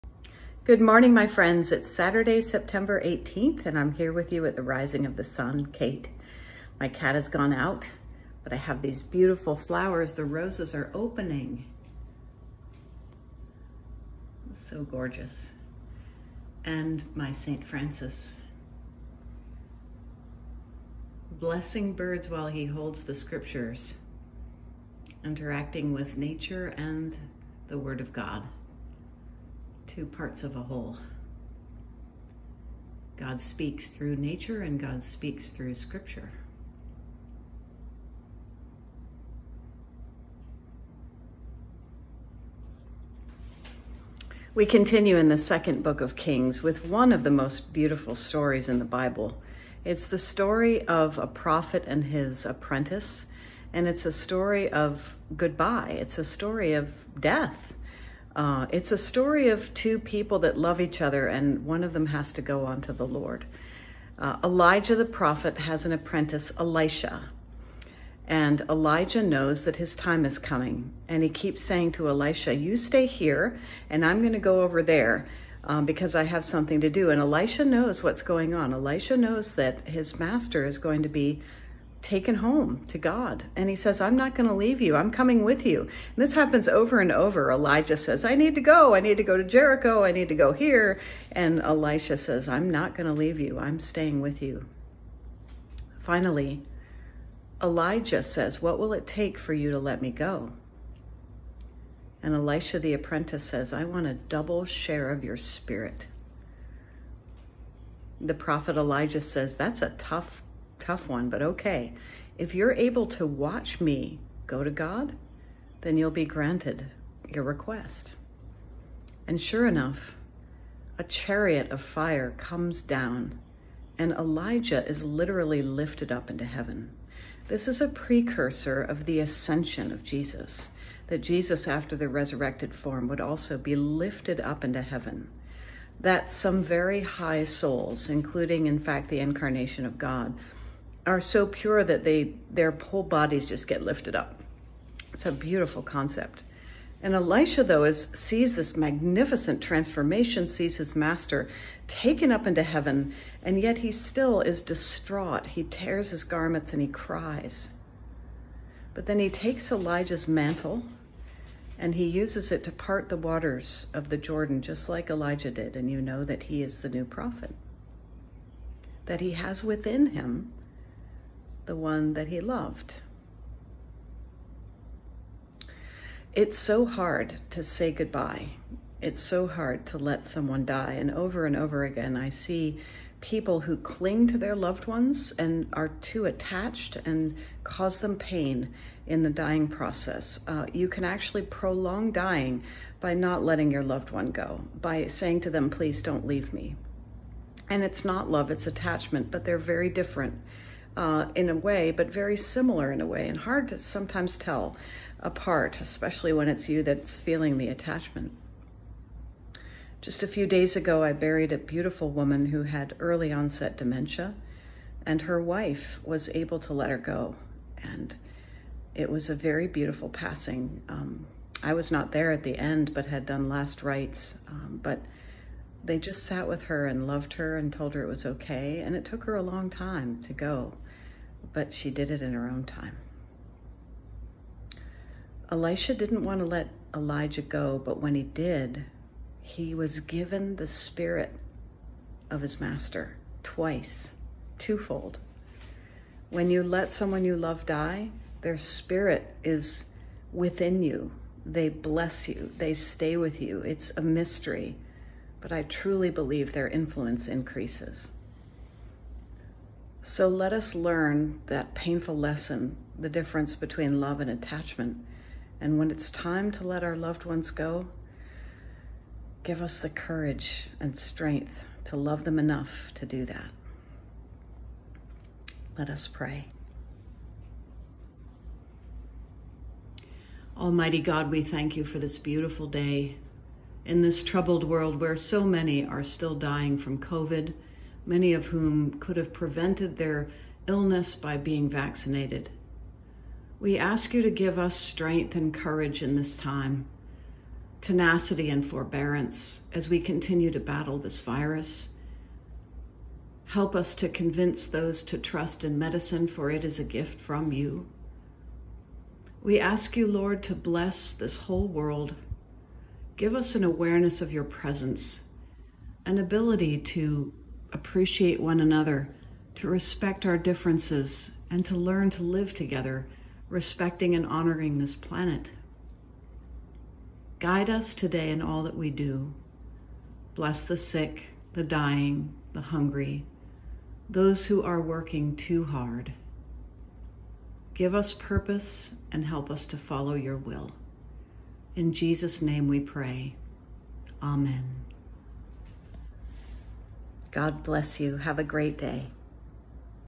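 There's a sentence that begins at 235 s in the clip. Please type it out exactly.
Elisha didn't want to let Elijah go, but when he did, he was given the spirit of his master twice, twofold.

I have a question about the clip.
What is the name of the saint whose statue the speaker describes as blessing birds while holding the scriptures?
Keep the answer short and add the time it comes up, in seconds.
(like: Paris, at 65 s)
St. Francis, at 17 s.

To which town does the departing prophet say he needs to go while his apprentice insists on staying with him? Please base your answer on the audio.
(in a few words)
Jericho.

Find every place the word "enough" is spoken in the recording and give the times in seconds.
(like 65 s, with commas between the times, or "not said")
119 s, 272 s.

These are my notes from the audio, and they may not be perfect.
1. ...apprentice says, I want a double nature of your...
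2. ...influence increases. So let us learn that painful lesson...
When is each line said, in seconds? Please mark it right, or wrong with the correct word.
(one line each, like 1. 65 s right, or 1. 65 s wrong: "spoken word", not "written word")
1. 102 s wrong: "share", not "nature"
2. 256 s right.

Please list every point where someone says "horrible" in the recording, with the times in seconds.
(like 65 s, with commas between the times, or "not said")
not said.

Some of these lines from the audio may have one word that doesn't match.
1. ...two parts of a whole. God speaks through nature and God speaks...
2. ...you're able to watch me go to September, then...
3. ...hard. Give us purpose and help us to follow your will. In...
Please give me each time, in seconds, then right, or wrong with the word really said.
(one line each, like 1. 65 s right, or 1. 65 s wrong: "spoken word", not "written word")
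1. 29 s right
2. 112 s wrong: "God", not "September"
3. 335 s right.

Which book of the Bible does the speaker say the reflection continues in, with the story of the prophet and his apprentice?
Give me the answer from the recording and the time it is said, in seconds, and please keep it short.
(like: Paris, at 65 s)
Second book of Kings, at 45 s.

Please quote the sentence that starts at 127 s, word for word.
This is a precursor of the ascension of Jesus, that Jesus, after the resurrected form, would also be lifted up into heaven.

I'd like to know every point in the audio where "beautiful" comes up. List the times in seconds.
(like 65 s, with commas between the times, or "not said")
9 s, 47 s, 145 s, 211 s, 219 s, 282 s.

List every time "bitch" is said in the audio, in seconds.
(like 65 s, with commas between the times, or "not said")
not said.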